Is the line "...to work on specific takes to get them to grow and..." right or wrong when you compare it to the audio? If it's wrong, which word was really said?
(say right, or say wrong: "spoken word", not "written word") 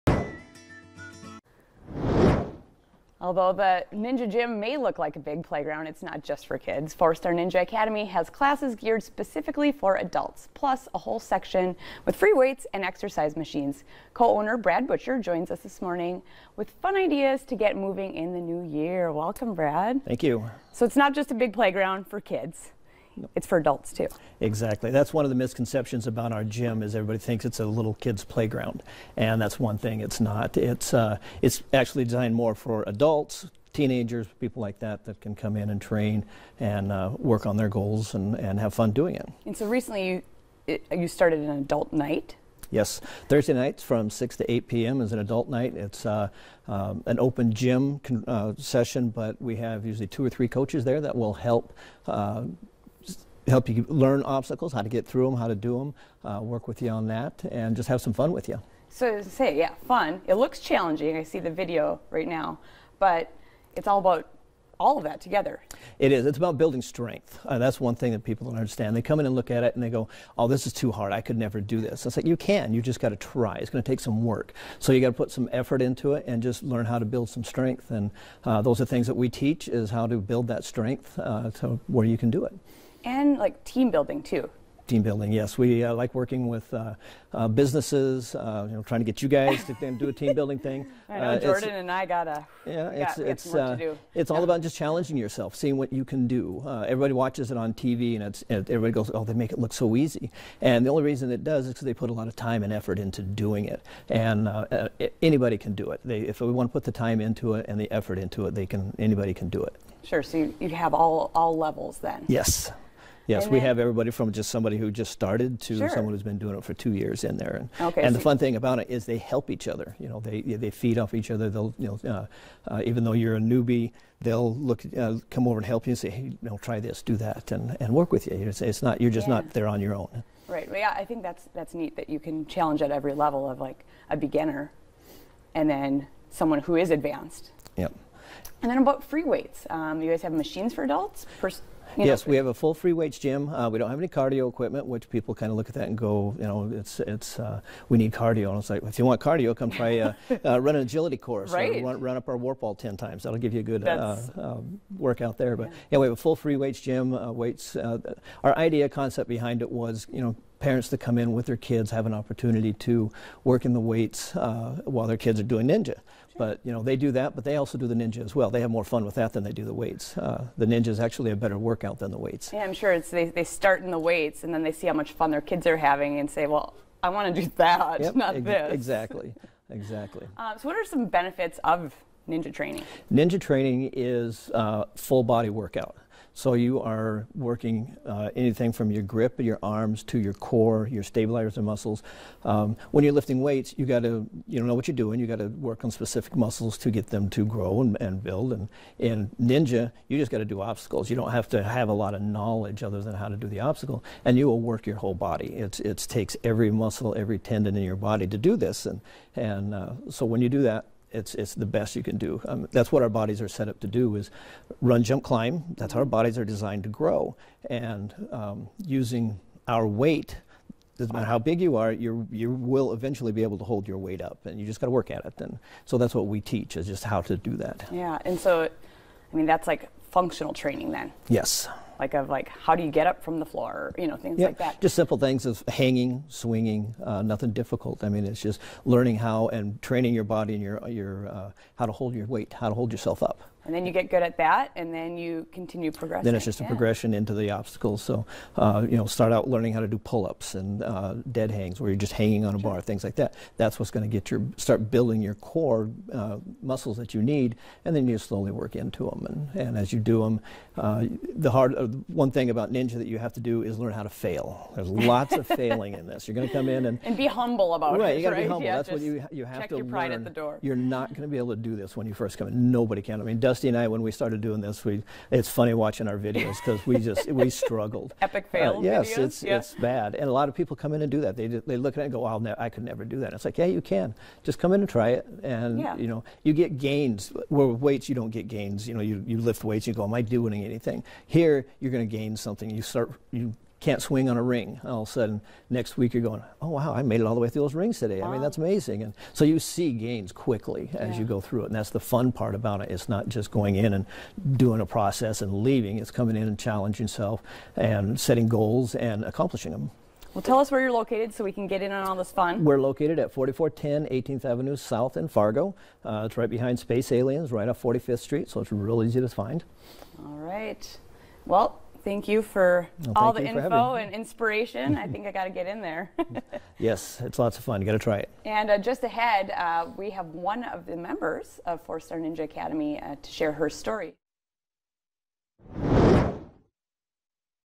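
wrong: "muscles", not "takes".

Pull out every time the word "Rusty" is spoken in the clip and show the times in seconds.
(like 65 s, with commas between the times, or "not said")
273 s.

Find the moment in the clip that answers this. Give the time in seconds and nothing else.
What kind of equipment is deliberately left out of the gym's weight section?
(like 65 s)
144 s.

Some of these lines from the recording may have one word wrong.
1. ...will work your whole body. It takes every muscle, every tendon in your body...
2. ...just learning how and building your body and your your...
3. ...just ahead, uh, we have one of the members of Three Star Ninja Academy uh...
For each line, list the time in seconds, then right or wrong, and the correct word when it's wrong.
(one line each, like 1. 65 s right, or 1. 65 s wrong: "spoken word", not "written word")
1. 204 s right
2. 238 s wrong: "training", not "building"
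3. 328 s wrong: "Four", not "Three".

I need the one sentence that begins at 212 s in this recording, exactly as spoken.
Um, that's what our bodies are set up to do is run, jump, climb.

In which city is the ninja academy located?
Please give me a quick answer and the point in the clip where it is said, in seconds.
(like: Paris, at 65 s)
Fargo, at 315 s.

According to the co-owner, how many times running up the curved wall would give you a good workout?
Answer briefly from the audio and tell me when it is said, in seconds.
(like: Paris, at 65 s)
10, at 152 s.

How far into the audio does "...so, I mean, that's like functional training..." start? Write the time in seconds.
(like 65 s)
228 s.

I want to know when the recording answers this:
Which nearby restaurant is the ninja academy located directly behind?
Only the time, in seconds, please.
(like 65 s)
316 s.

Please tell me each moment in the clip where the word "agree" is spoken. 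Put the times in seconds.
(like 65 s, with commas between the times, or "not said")
not said.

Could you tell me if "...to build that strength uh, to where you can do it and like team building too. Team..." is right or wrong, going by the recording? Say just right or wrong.
right.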